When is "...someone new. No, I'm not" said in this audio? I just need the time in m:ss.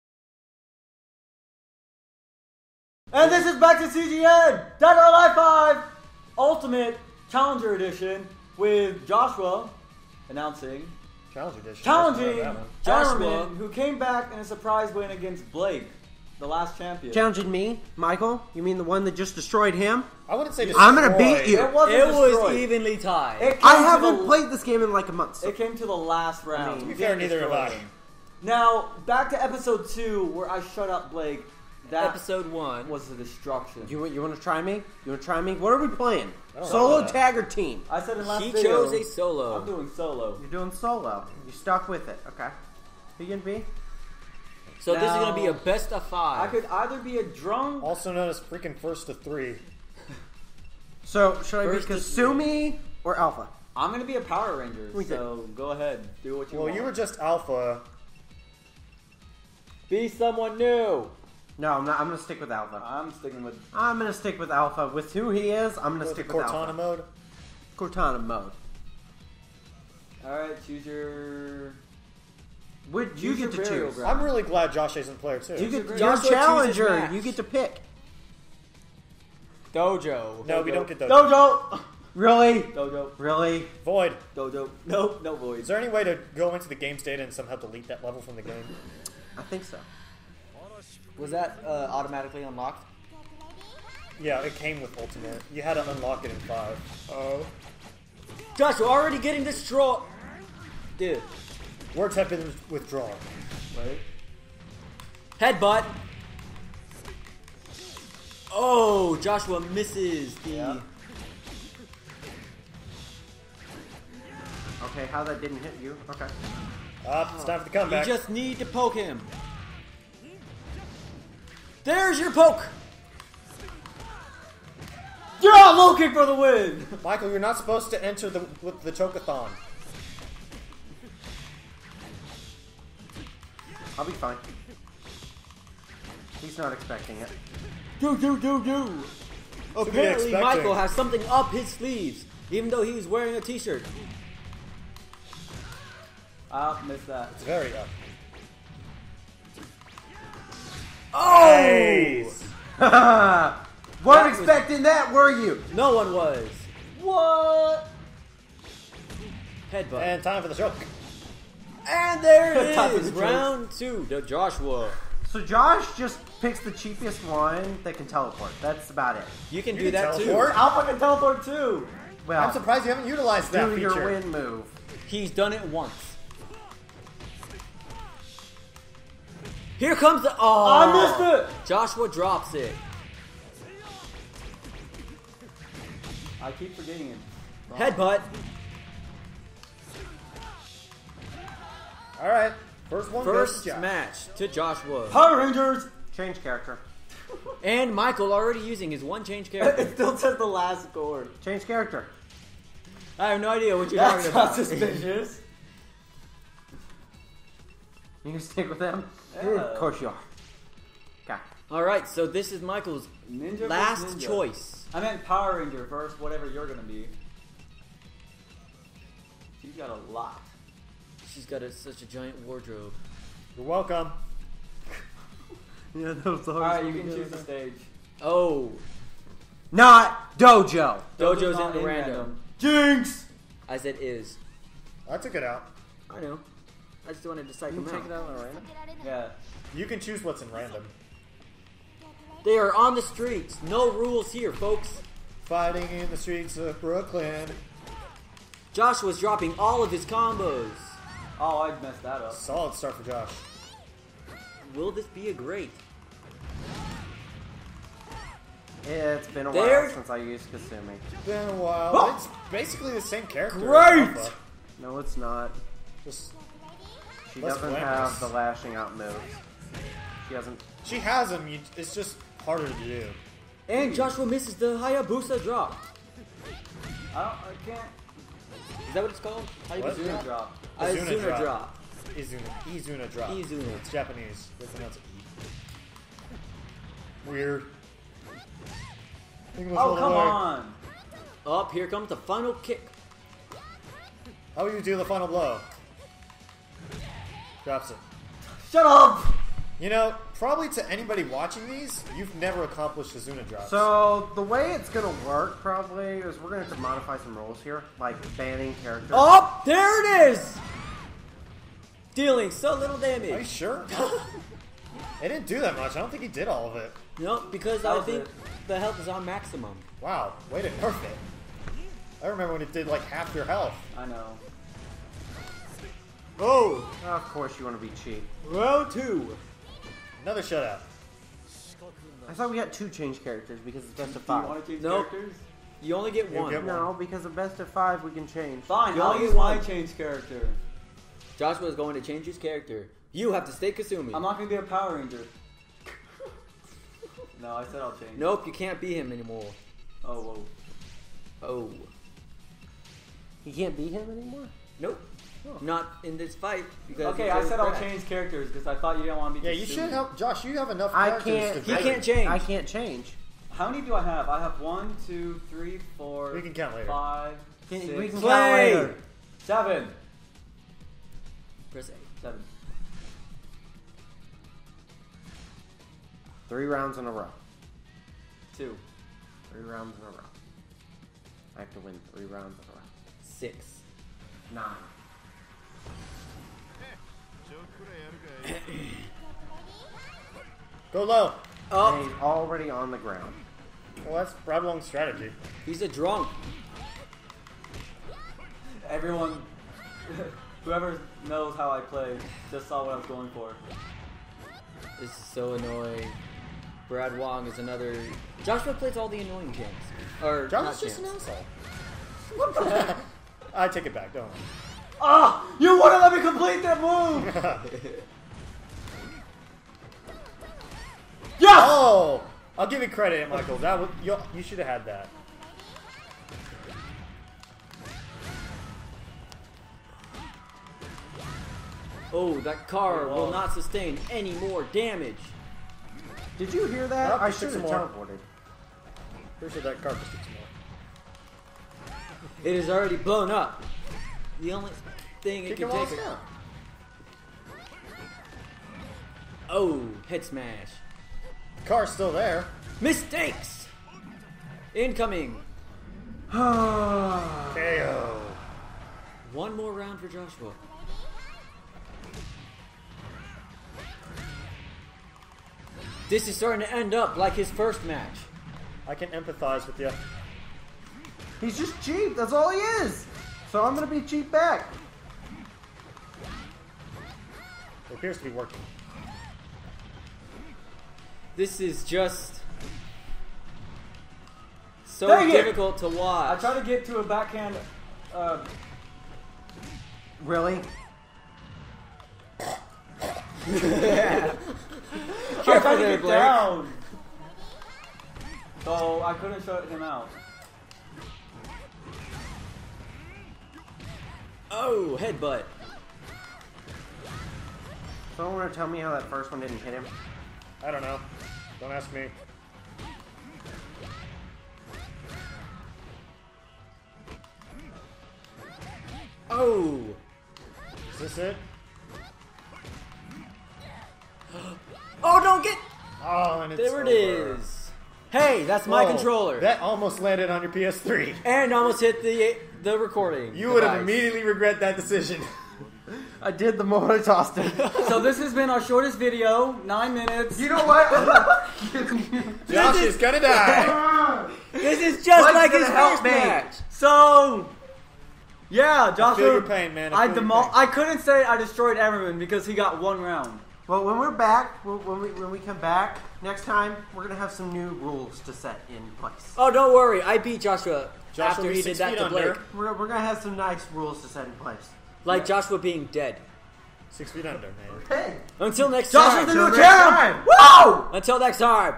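1:00.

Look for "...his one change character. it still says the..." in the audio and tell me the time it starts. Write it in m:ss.
3:18.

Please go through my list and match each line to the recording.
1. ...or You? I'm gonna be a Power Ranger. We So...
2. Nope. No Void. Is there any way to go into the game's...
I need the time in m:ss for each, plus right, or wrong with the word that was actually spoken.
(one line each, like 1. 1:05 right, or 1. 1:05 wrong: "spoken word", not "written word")
1. 0:53 wrong: "Alpha", not "You"
2. 1:24 right.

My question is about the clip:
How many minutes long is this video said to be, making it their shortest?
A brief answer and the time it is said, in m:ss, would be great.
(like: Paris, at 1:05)
9, at 8:59.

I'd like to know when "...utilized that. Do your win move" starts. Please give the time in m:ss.
2:53.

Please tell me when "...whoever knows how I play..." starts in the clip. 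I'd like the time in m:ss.
6:40.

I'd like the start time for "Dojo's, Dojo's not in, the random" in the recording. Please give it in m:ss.
3:51.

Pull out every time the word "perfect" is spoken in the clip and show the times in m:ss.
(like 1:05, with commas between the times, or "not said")
5:20.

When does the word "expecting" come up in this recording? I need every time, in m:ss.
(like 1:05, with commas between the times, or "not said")
2:16, 2:34.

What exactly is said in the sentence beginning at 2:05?
You're looking low kick for the win.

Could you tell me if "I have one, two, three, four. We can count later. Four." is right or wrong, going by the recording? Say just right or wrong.
wrong.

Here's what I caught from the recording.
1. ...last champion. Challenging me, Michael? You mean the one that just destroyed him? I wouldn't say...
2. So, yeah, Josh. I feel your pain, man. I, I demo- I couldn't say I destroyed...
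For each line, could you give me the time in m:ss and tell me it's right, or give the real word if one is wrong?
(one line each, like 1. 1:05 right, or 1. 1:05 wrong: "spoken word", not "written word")
1. 0:16 right
2. 9:06 right.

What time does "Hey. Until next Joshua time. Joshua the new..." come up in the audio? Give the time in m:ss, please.
9:27.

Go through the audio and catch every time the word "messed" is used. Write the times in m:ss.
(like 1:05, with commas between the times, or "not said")
4:11.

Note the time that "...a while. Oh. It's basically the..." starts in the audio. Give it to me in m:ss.
4:21.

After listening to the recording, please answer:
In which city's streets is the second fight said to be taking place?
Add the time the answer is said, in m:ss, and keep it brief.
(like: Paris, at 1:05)
Brooklyn, at 4:06.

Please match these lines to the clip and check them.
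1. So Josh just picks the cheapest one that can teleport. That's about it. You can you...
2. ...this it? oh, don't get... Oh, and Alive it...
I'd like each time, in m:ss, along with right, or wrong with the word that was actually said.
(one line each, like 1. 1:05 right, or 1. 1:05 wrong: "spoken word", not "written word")
1. 2:45 right
2. 8:40 wrong: "There", not "Alive".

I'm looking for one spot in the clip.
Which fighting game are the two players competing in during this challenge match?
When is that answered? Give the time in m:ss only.
0:04.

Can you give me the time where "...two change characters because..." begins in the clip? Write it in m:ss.
5:32.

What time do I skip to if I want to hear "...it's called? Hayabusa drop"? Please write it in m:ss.
4:39.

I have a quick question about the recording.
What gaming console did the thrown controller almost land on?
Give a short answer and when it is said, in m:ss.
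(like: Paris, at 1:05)
PS3, at 8:50.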